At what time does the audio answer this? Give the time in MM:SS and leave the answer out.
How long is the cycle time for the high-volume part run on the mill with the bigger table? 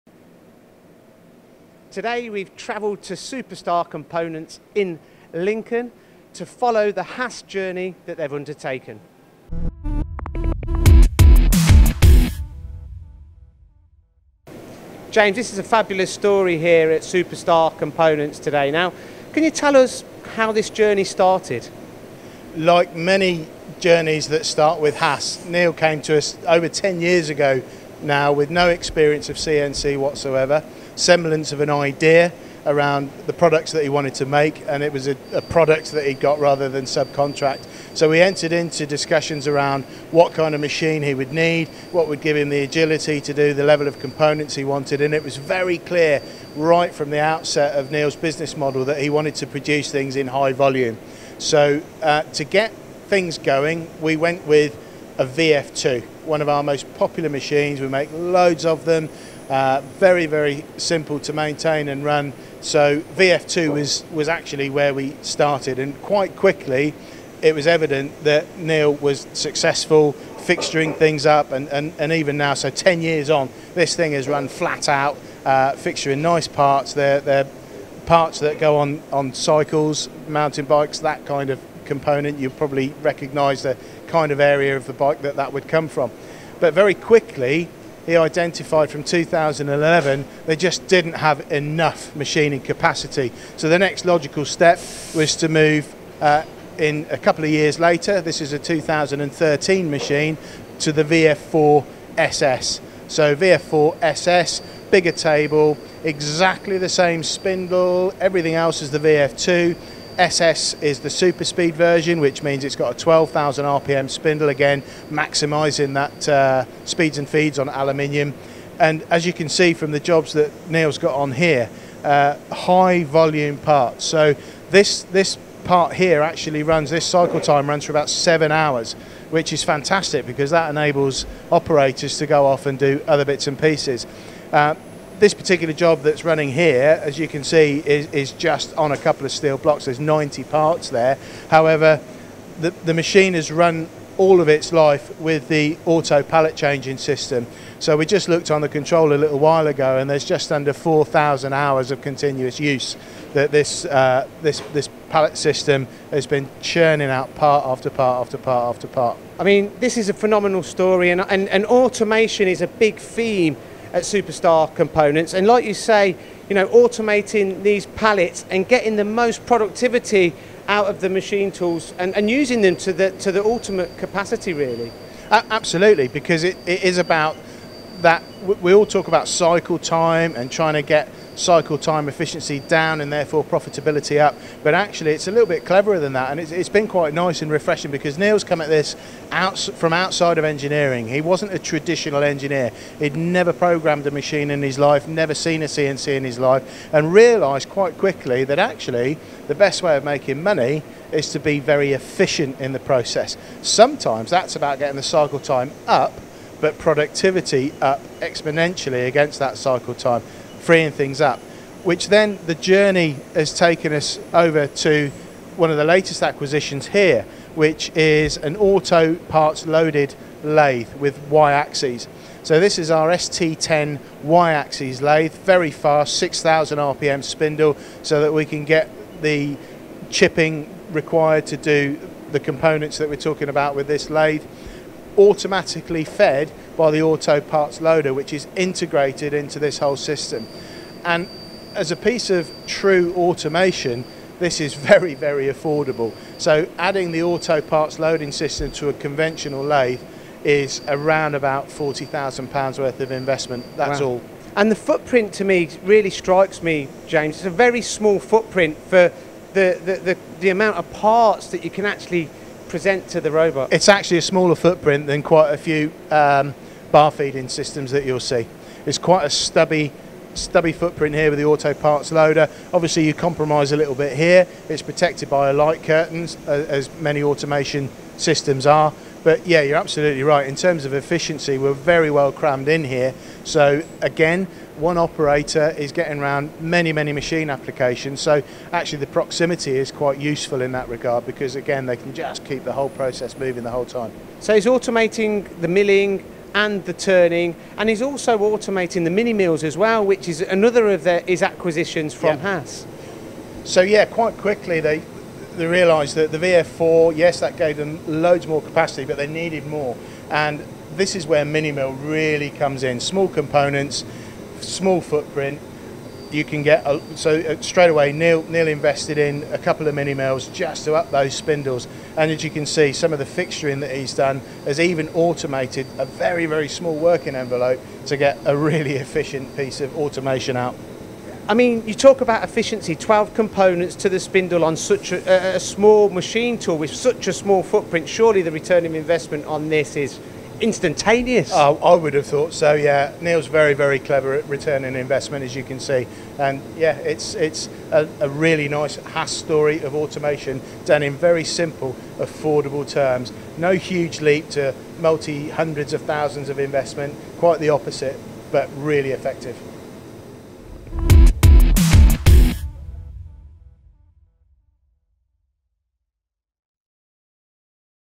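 02:07.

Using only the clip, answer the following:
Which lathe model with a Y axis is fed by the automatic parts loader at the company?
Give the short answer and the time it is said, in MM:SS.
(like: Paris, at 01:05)
ST10, at 03:43.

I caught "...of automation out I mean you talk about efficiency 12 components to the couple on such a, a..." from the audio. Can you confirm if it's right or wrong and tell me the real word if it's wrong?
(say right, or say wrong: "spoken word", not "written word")
wrong: "spindle", not "couple".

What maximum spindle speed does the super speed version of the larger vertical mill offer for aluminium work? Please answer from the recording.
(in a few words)
12,000 RPM.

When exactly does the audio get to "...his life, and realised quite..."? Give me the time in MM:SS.
03:16.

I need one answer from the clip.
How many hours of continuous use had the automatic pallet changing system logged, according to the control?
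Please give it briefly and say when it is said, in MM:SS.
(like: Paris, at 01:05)
just under 4,000 hours, at 02:30.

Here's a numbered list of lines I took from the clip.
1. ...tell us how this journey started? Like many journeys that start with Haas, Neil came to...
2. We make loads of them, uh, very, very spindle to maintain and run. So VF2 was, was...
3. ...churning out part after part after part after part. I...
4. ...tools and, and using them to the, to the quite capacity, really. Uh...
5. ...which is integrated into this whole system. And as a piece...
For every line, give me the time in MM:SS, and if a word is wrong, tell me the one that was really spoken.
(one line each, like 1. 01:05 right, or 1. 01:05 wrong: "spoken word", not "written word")
1. 00:19 right
2. 00:57 wrong: "simple", not "spindle"
3. 02:36 right
4. 02:51 wrong: "ultimate", not "quite"
5. 03:58 right.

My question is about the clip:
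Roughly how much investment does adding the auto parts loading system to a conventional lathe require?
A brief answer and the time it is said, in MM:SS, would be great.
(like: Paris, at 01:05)
£40,000, at 04:11.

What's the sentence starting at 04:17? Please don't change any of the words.
It's a very small footprint for the, the, the, the amount of parts that you can actually present to the robot?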